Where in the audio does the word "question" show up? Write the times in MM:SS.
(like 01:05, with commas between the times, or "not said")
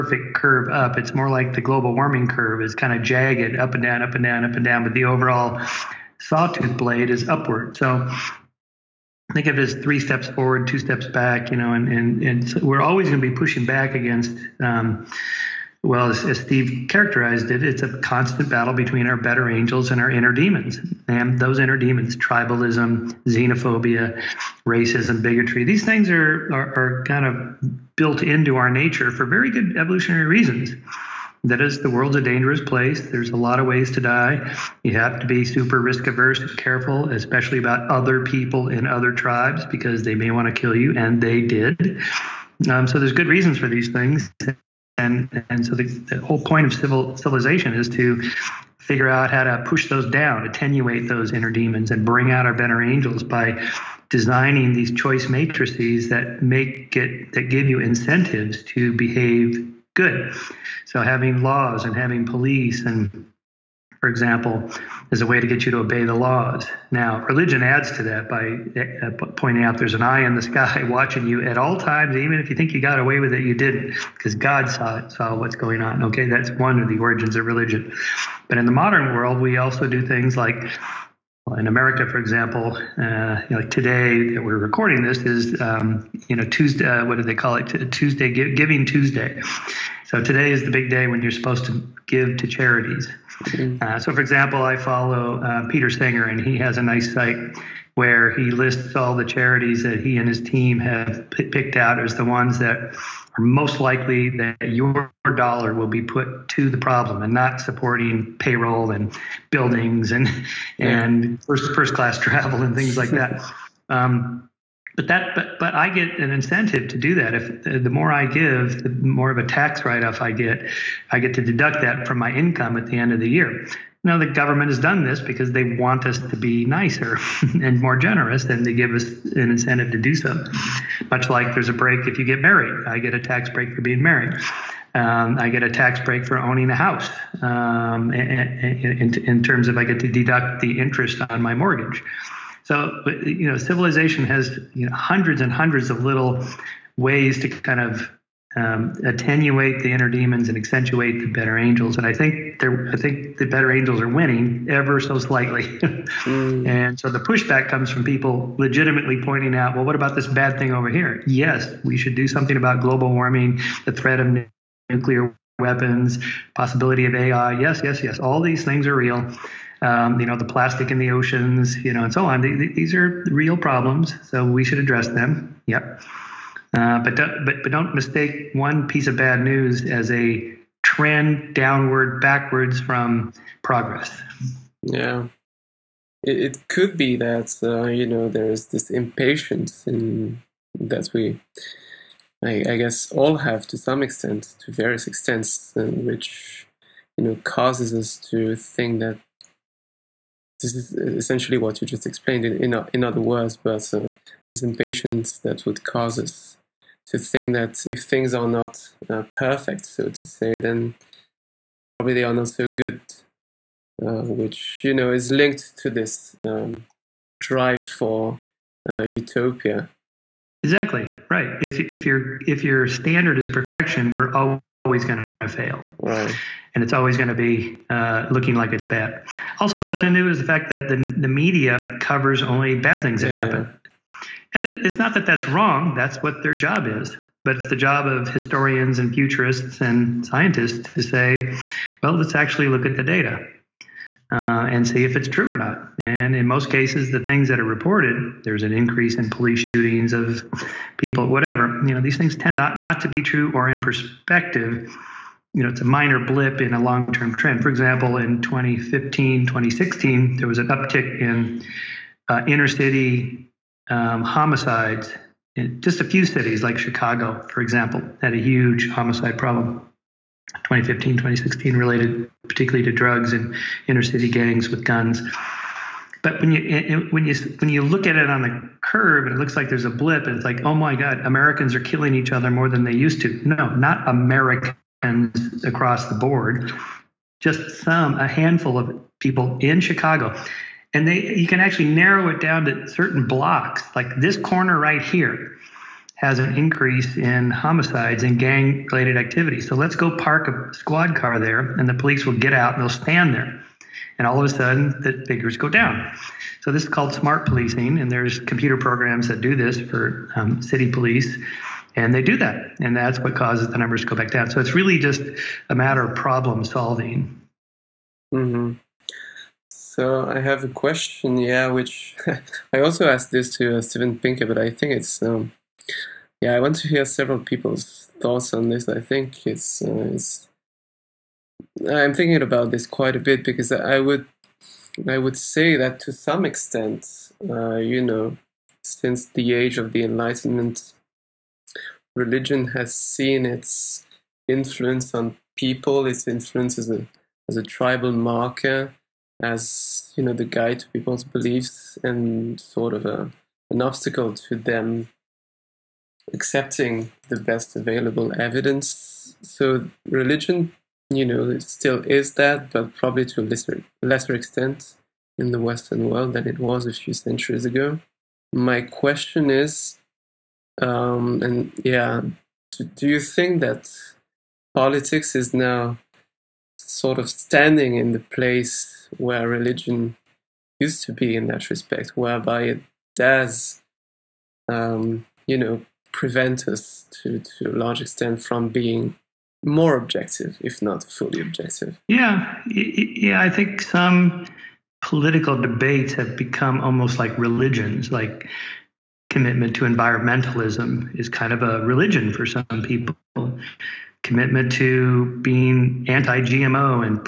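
05:20, 06:08.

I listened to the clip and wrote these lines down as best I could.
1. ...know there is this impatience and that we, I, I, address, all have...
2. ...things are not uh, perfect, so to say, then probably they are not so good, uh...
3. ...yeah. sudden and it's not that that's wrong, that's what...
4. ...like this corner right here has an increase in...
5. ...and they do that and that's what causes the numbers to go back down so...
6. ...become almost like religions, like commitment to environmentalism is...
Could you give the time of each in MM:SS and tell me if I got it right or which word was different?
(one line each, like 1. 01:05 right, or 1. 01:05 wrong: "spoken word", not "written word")
1. 03:08 wrong: "guess", not "address"
2. 03:28 right
3. 03:53 wrong: "happen", not "sudden"
4. 04:53 right
5. 05:11 right
6. 06:36 right.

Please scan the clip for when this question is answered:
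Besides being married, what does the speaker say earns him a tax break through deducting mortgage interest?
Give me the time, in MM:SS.
02:16.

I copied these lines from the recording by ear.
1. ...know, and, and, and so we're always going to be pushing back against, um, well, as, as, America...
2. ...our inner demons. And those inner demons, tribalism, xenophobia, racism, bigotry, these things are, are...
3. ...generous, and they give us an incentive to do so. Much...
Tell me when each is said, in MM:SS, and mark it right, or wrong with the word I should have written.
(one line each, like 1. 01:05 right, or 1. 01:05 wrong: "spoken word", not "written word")
1. 00:11 wrong: "Steve", not "America"
2. 00:20 right
3. 02:07 right.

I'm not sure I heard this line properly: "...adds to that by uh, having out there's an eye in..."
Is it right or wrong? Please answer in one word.
wrong.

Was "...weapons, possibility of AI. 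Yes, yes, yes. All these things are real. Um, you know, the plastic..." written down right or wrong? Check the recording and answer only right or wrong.
right.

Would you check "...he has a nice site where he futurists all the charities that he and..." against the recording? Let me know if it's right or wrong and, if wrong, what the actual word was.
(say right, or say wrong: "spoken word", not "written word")
wrong: "lists", not "futurists".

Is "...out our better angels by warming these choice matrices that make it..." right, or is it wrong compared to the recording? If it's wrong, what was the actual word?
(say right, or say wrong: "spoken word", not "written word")
wrong: "designing", not "warming".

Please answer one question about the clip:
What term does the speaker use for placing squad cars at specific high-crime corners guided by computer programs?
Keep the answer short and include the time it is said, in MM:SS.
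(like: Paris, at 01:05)
smart policing, at 05:07.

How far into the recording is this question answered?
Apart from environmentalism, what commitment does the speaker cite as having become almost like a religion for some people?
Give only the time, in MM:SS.
06:45.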